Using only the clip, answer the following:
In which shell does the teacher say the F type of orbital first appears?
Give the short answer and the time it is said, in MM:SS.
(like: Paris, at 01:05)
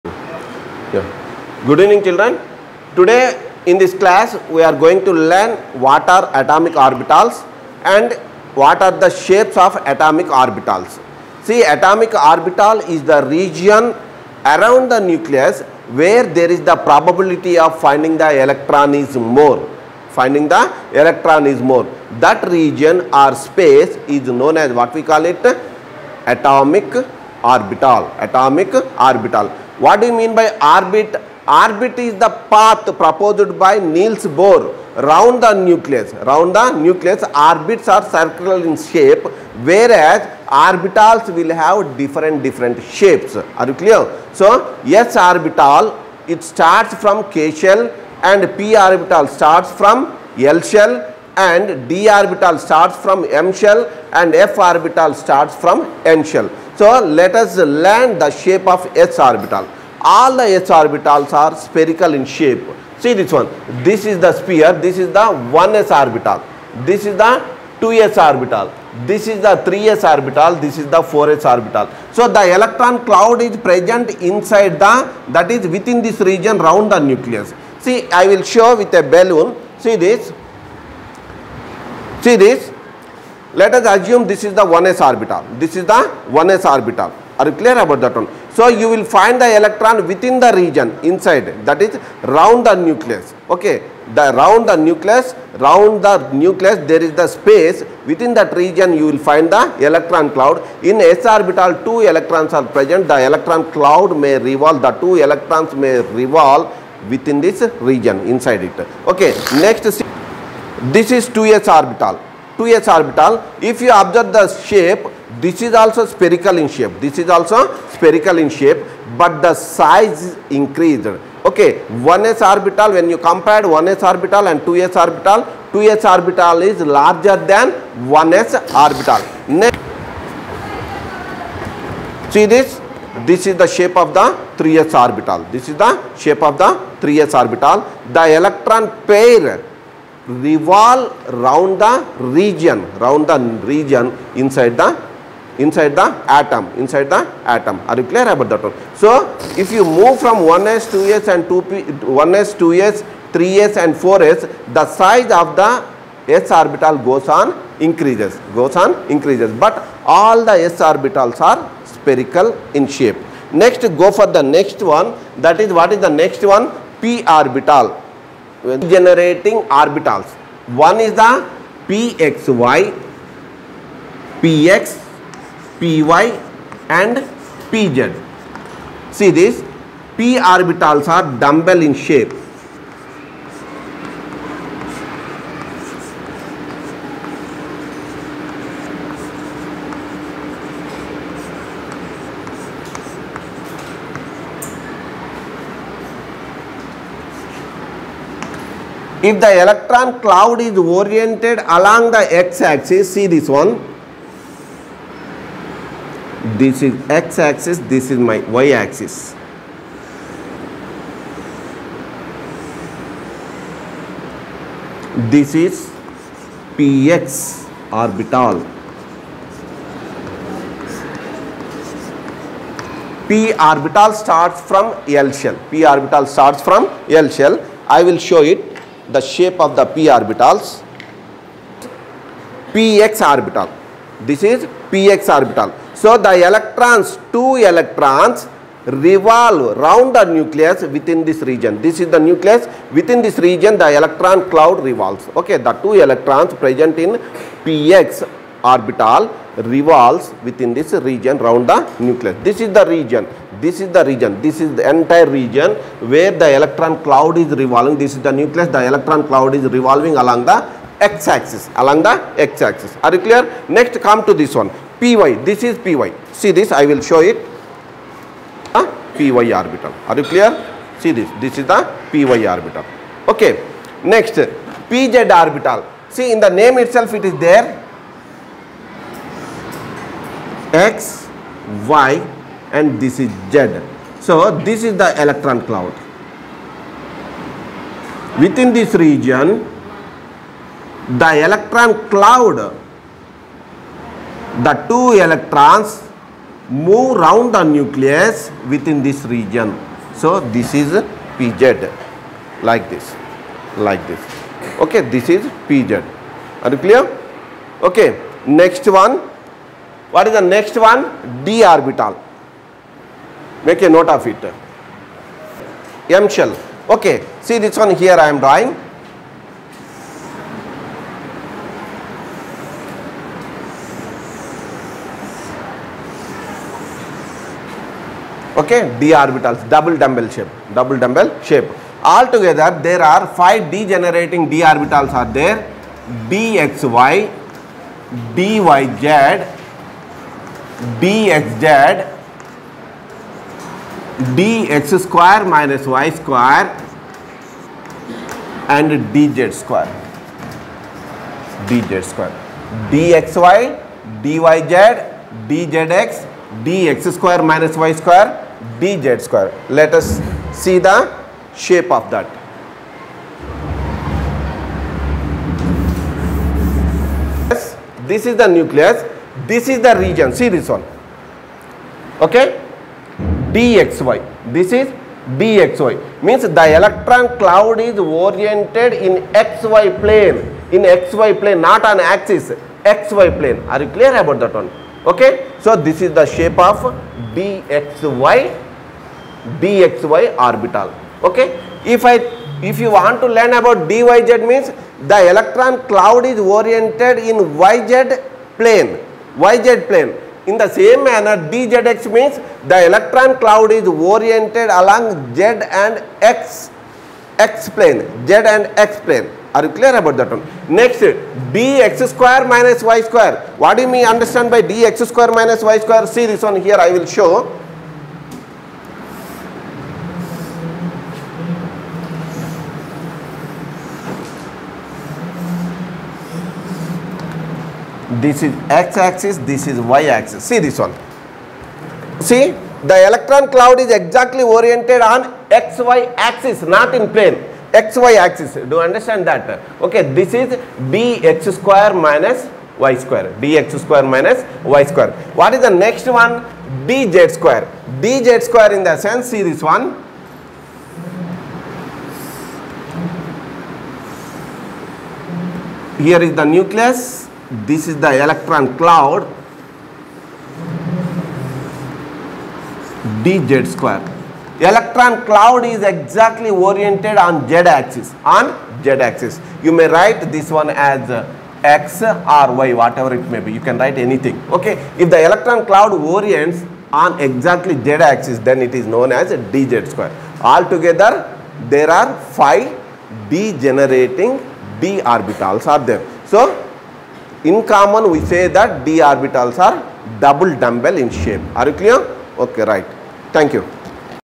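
N shell, at 00:56.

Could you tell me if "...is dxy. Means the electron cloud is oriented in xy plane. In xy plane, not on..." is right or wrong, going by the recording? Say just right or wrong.
right.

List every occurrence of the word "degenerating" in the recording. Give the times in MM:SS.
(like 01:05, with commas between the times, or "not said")
05:33, 08:03.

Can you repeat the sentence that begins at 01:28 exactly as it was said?
So you will find the electron within the region inside that is round the nucleus.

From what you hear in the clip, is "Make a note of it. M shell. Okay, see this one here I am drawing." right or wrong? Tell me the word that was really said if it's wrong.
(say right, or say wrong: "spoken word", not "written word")
right.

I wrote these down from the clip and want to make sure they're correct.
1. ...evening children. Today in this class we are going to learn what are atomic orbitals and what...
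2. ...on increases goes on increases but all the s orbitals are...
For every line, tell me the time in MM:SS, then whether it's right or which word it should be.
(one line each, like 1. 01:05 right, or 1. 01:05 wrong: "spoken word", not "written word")
1. 00:01 right
2. 02:37 right.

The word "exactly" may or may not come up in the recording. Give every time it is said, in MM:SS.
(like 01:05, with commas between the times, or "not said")
07:13, 07:45, 07:57.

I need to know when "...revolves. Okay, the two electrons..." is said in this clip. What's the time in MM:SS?
04:04.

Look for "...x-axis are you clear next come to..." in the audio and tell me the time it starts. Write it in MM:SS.
04:22.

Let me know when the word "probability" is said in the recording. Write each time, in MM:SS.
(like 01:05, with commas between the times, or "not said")
00:16.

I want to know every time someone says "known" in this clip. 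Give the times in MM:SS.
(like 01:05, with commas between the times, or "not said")
00:24, 07:58.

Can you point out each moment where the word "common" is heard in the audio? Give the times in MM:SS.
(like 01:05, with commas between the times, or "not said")
08:07.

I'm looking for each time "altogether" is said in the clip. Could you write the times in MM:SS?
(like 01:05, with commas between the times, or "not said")
05:32, 08:00.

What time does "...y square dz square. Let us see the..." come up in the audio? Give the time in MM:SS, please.
05:57.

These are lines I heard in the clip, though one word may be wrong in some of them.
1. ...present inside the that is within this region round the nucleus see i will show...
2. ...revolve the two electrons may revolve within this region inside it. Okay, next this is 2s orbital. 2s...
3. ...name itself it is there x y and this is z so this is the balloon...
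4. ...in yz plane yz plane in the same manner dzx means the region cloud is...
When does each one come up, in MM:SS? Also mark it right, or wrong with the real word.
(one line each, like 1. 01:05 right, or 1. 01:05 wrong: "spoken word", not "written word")
1. 01:13 right
2. 01:44 right
3. 04:36 wrong: "electron", not "balloon"
4. 06:37 wrong: "electron", not "region".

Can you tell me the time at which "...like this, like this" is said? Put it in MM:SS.
05:02.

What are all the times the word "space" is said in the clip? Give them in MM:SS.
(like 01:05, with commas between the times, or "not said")
00:23, 01:37.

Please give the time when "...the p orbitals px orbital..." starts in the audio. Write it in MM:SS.
03:49.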